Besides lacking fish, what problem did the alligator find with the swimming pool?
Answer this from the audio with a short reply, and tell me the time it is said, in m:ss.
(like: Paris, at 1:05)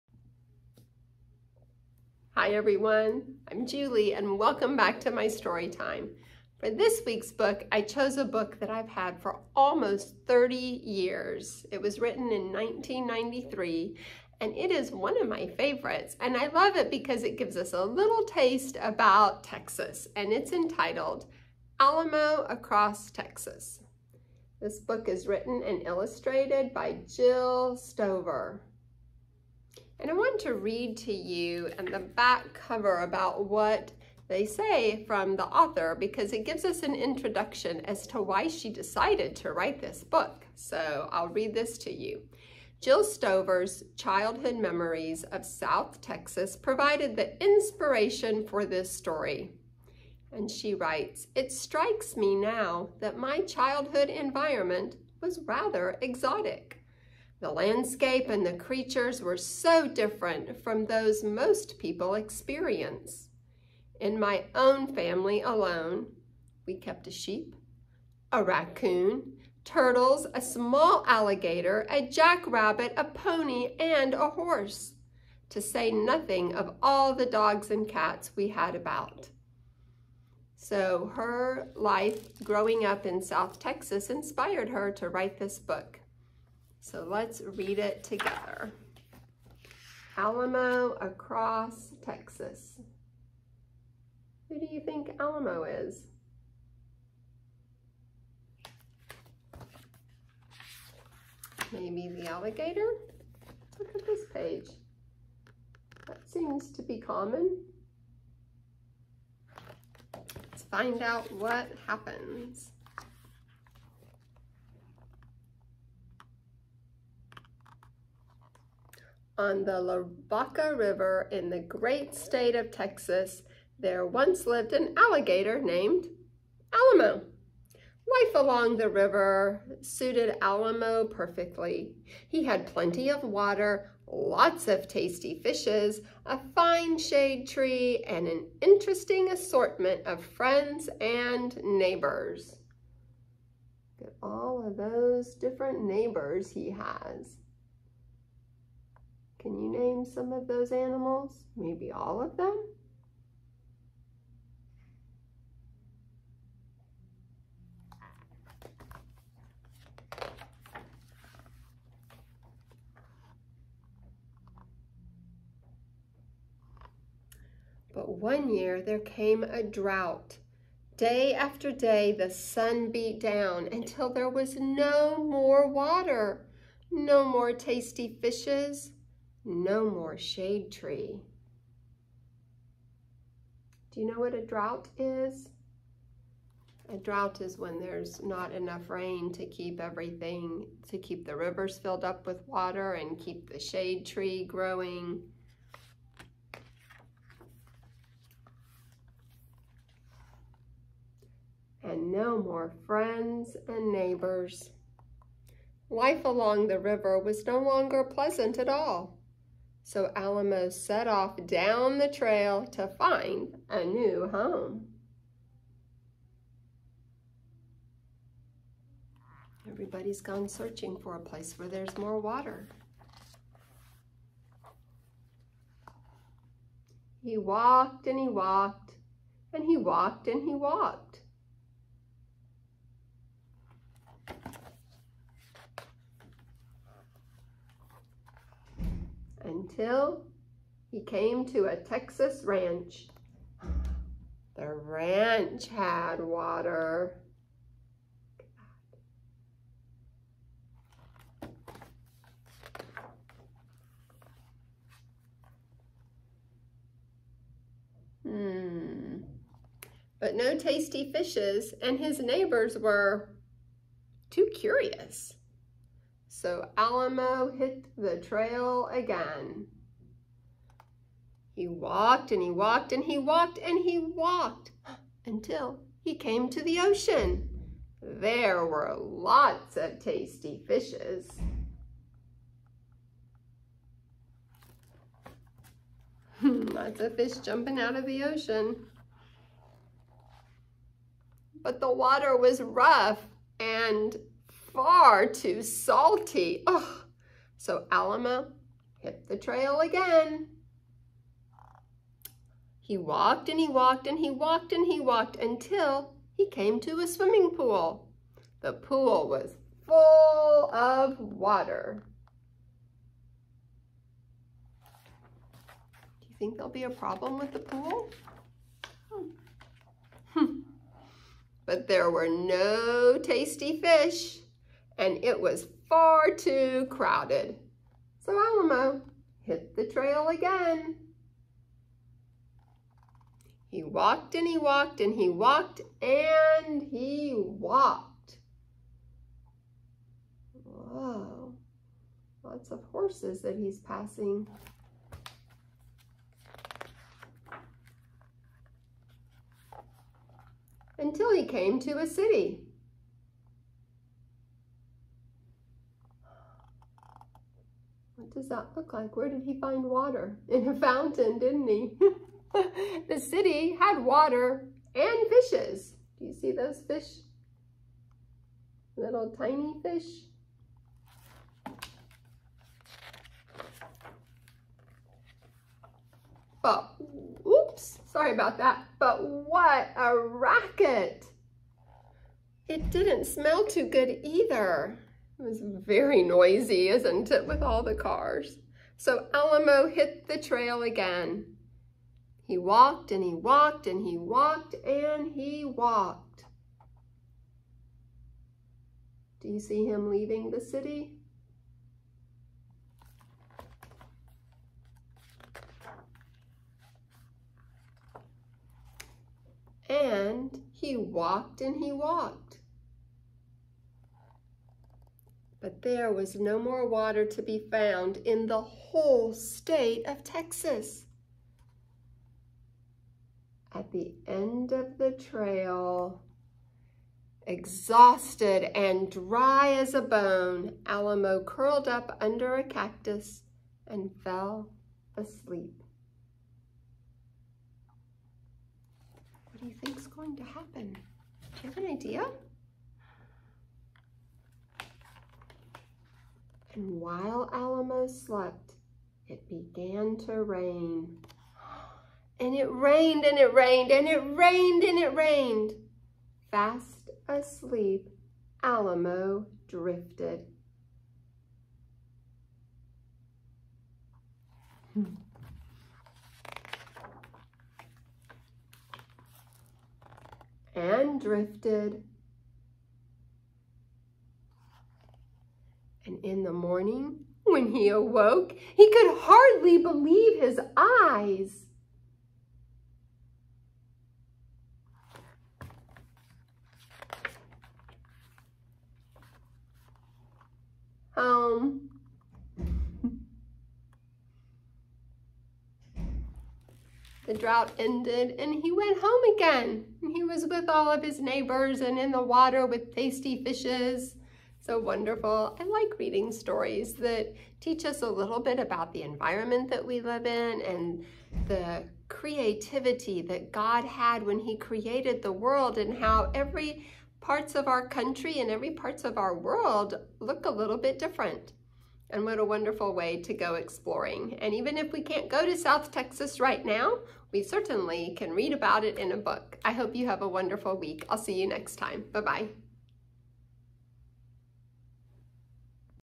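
far too crowded, at 5:25.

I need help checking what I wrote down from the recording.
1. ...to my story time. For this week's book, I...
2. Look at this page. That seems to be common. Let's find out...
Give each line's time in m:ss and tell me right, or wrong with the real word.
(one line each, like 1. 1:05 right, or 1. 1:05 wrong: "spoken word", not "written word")
1. 0:05 right
2. 1:43 right.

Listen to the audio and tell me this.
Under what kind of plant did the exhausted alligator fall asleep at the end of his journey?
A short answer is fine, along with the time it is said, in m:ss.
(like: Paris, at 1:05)
a cactus, at 7:12.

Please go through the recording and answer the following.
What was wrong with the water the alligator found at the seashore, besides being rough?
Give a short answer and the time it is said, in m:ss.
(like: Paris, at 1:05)
far too salty, at 4:54.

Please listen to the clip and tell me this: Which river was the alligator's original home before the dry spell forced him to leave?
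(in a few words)
Lavaca River.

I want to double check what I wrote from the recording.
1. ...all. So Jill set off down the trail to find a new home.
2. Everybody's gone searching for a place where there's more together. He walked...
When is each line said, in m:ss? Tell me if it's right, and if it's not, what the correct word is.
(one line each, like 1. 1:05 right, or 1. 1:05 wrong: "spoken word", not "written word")
1. 3:28 wrong: "Alamo", not "Jill"
2. 3:39 wrong: "water", not "together".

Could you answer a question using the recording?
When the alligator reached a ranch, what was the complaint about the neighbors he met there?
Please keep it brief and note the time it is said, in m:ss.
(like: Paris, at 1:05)
too curious, at 4:24.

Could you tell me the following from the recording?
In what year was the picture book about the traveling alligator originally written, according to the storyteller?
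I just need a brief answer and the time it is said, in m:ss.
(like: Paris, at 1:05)
1993, at 0:12.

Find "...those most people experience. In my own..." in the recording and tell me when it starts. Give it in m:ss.
1:00.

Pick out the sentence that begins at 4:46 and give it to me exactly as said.
Hmm, lots of fish jumping out of the ocean.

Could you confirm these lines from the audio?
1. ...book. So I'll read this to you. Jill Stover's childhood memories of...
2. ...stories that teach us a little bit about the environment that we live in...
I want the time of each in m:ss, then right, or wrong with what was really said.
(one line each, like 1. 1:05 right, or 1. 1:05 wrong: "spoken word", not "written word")
1. 0:40 right
2. 8:26 right.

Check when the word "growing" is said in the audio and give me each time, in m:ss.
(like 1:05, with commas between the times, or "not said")
1:22, 3:14.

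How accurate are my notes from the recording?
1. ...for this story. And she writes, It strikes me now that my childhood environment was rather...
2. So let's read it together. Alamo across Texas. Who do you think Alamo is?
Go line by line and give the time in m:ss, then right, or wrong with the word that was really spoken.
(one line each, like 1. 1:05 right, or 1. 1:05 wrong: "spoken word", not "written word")
1. 0:48 right
2. 1:26 right.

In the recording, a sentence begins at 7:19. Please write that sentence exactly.
What do you think's going to happen?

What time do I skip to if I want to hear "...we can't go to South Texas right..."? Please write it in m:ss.
8:44.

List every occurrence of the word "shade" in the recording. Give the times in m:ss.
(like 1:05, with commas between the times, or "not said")
2:16, 3:00, 3:13.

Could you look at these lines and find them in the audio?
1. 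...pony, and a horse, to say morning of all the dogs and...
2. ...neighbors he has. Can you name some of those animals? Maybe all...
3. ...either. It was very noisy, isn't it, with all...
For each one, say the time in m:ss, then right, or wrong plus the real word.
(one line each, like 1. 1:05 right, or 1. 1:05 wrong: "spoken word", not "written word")
1. 1:13 wrong: "nothing", not "morning"
2. 2:25 right
3. 6:24 right.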